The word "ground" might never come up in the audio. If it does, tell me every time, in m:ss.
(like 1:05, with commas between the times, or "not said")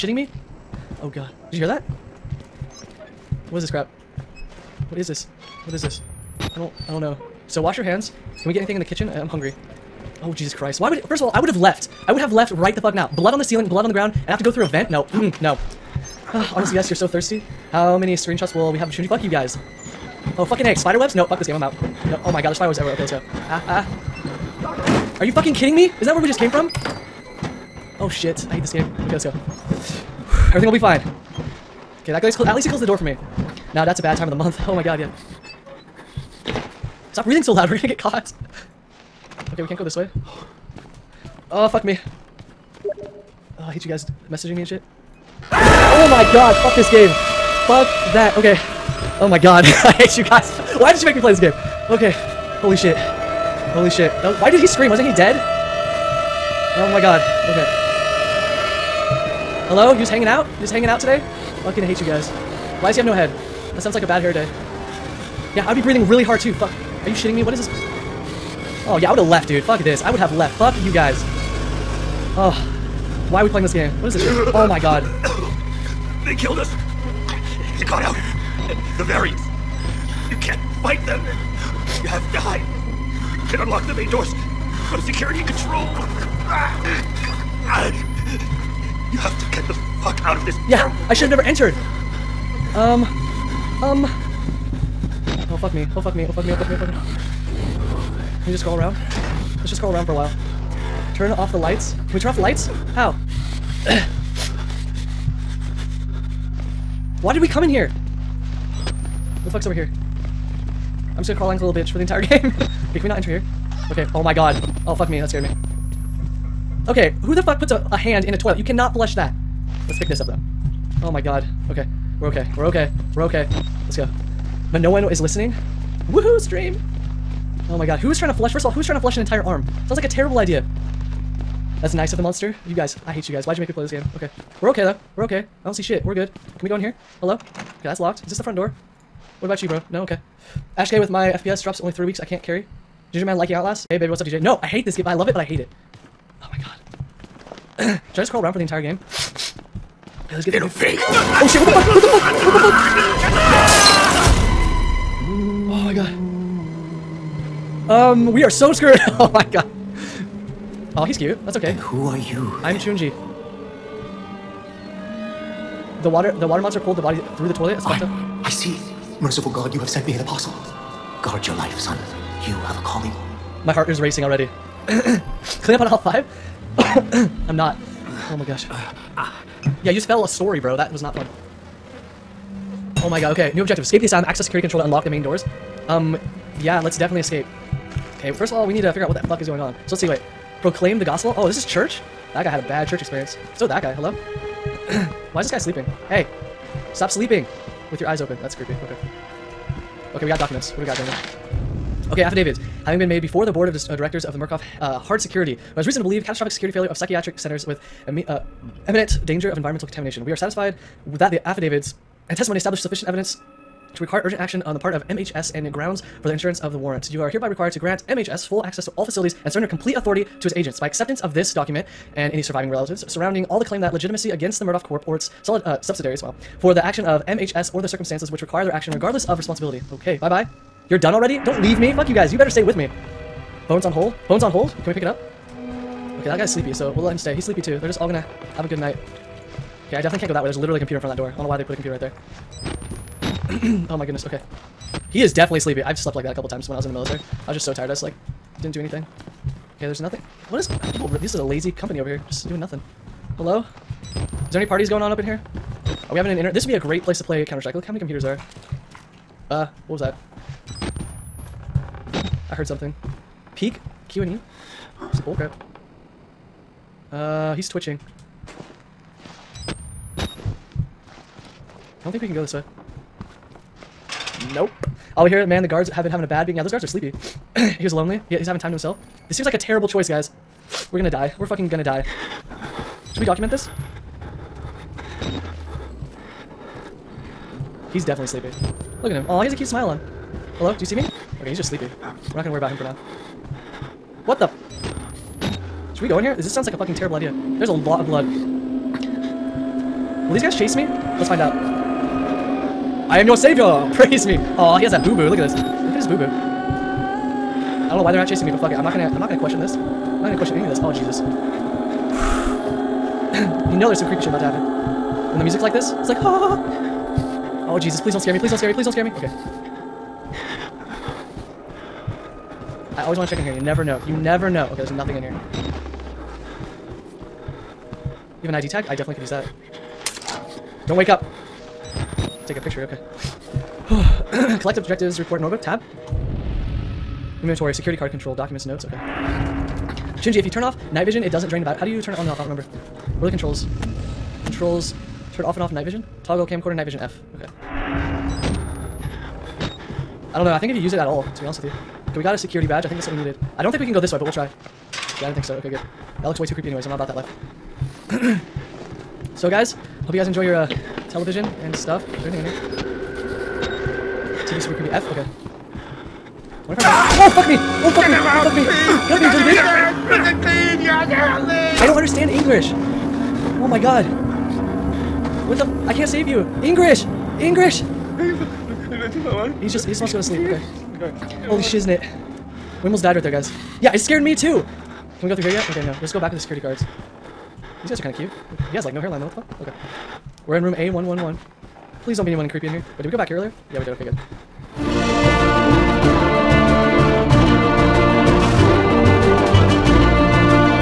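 0:13, 3:35.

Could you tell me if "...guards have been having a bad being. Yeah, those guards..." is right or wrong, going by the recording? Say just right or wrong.
right.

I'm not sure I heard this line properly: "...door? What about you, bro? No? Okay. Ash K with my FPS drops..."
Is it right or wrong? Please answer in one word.
right.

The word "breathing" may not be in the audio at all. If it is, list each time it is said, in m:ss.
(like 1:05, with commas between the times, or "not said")
0:37, 1:05.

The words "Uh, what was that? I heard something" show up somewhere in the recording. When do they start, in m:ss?
4:19.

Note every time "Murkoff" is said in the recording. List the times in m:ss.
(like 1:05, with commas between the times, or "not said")
3:24, 3:44.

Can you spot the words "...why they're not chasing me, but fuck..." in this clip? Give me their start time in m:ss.
5:08.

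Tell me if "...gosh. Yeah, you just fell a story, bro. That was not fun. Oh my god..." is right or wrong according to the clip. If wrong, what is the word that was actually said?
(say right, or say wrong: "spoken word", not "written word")
right.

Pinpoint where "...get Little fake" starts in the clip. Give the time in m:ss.
2:30.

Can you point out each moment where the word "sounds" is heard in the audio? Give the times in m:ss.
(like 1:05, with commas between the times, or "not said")
1:03, 2:09, 4:56.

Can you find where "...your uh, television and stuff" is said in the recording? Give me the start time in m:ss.
6:00.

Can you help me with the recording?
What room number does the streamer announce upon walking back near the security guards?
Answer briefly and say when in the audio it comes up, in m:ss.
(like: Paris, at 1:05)
A111, at 6:30.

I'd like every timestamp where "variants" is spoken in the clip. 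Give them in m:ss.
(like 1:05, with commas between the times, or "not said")
1:19.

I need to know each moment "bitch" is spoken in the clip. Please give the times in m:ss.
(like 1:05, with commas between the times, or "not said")
1:51, 6:10.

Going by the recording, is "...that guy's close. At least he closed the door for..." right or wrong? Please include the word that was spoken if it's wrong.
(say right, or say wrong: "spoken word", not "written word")
right.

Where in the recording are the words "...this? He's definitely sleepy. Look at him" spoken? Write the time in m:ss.
4:43.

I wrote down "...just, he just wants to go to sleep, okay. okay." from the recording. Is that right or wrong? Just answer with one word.
right.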